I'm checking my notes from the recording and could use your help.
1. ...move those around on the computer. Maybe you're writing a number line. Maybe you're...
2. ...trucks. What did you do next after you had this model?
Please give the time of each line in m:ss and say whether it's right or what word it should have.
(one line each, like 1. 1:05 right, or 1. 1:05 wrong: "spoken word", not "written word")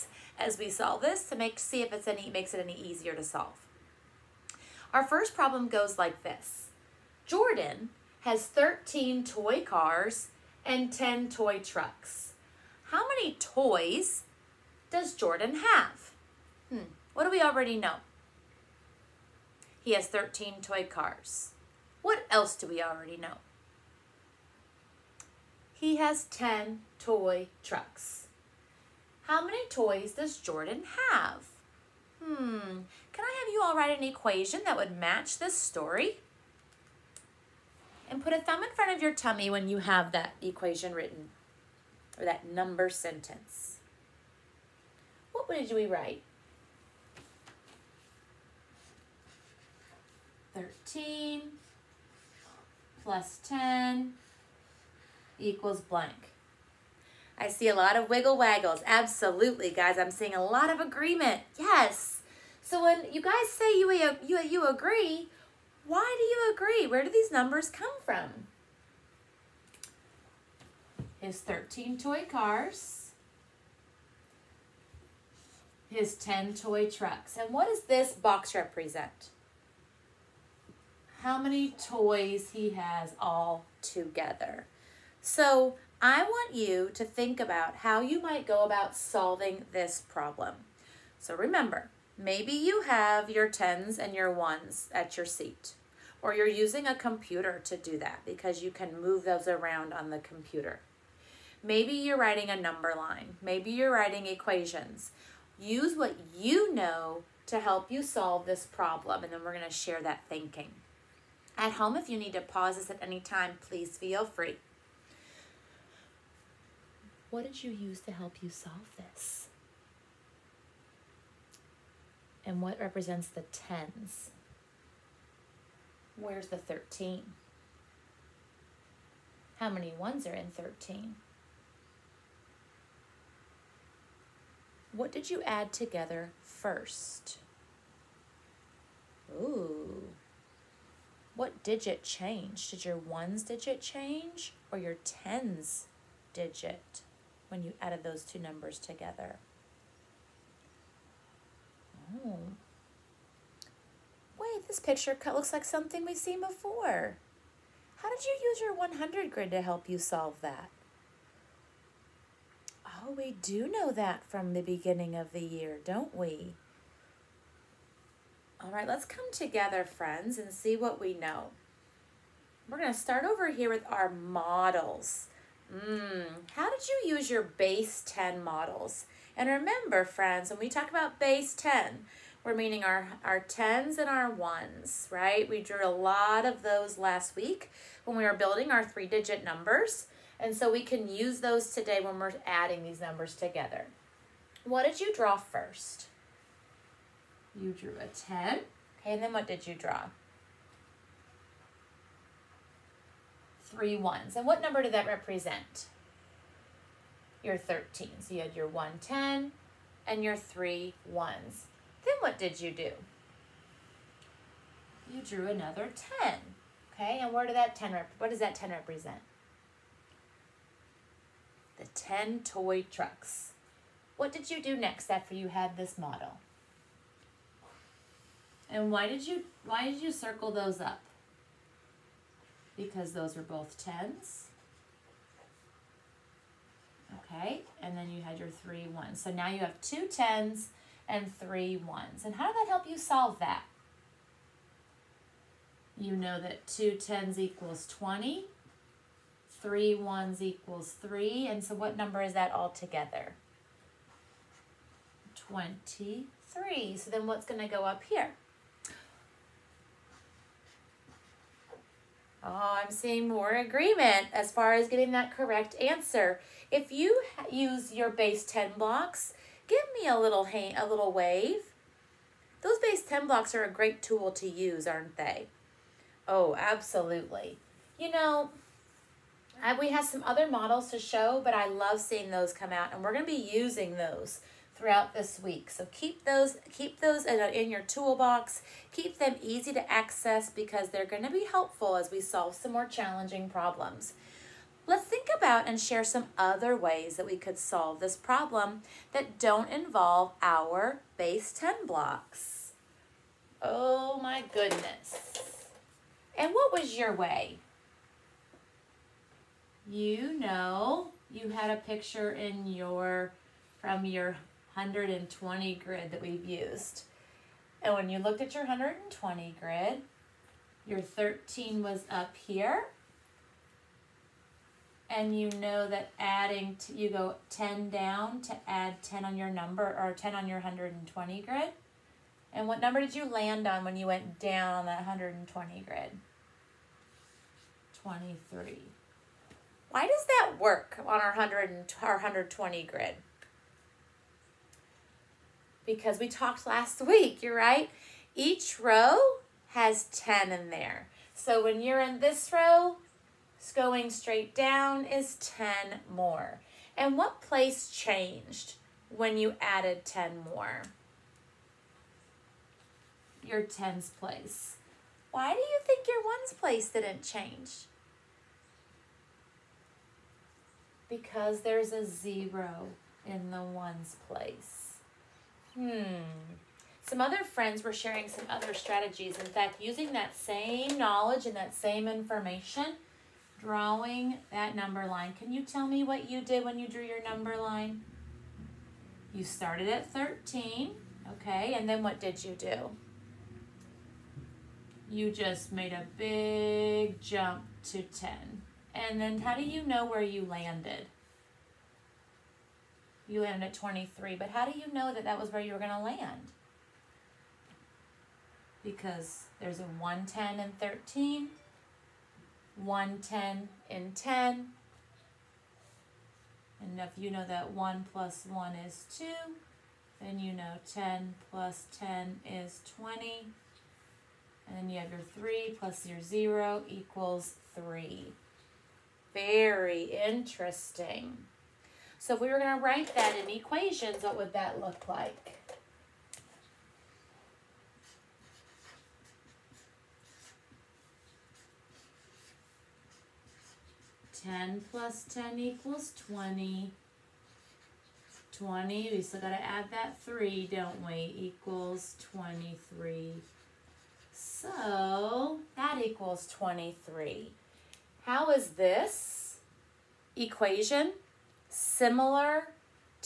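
1. 1:39 right
2. 3:42 right.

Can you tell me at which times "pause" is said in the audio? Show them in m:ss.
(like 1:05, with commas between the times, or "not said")
1:52.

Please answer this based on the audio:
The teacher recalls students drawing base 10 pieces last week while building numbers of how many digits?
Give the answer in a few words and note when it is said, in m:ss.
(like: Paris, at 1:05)
3, at 3:08.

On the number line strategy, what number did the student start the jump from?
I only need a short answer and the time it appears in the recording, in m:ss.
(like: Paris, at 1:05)
13, at 6:29.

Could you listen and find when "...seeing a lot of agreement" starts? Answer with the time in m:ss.
1:00.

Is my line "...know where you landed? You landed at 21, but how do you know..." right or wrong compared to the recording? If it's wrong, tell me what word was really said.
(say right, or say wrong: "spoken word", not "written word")
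wrong: "23", not "21".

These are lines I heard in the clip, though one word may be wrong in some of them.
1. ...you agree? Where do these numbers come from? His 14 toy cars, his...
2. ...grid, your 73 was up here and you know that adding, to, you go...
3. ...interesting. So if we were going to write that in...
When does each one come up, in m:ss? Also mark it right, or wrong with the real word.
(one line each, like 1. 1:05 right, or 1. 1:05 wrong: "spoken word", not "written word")
1. 1:06 wrong: "13", not "14"
2. 5:19 wrong: "13", not "73"
3. 7:10 right.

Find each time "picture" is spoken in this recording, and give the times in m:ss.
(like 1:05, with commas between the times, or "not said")
2:34, 5:11.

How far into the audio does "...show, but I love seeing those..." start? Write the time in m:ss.
4:40.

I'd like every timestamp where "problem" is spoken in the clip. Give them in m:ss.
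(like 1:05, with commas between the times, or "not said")
0:05, 1:30, 1:48, 4:53, 4:58.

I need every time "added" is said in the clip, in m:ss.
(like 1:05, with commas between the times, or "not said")
2:27, 5:59.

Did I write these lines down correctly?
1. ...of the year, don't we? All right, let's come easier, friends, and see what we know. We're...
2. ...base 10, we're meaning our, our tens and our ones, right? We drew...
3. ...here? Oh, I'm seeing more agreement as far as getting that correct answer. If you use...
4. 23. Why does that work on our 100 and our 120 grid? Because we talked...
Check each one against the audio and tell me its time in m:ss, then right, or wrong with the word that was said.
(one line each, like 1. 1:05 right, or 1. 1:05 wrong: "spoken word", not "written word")
1. 2:45 wrong: "together", not "easier"
2. 3:01 right
3. 4:18 right
4. 5:38 right.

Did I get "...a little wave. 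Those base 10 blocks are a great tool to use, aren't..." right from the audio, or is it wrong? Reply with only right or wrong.
right.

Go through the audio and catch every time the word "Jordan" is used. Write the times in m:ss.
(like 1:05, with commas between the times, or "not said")
0:07, 0:15, 0:30.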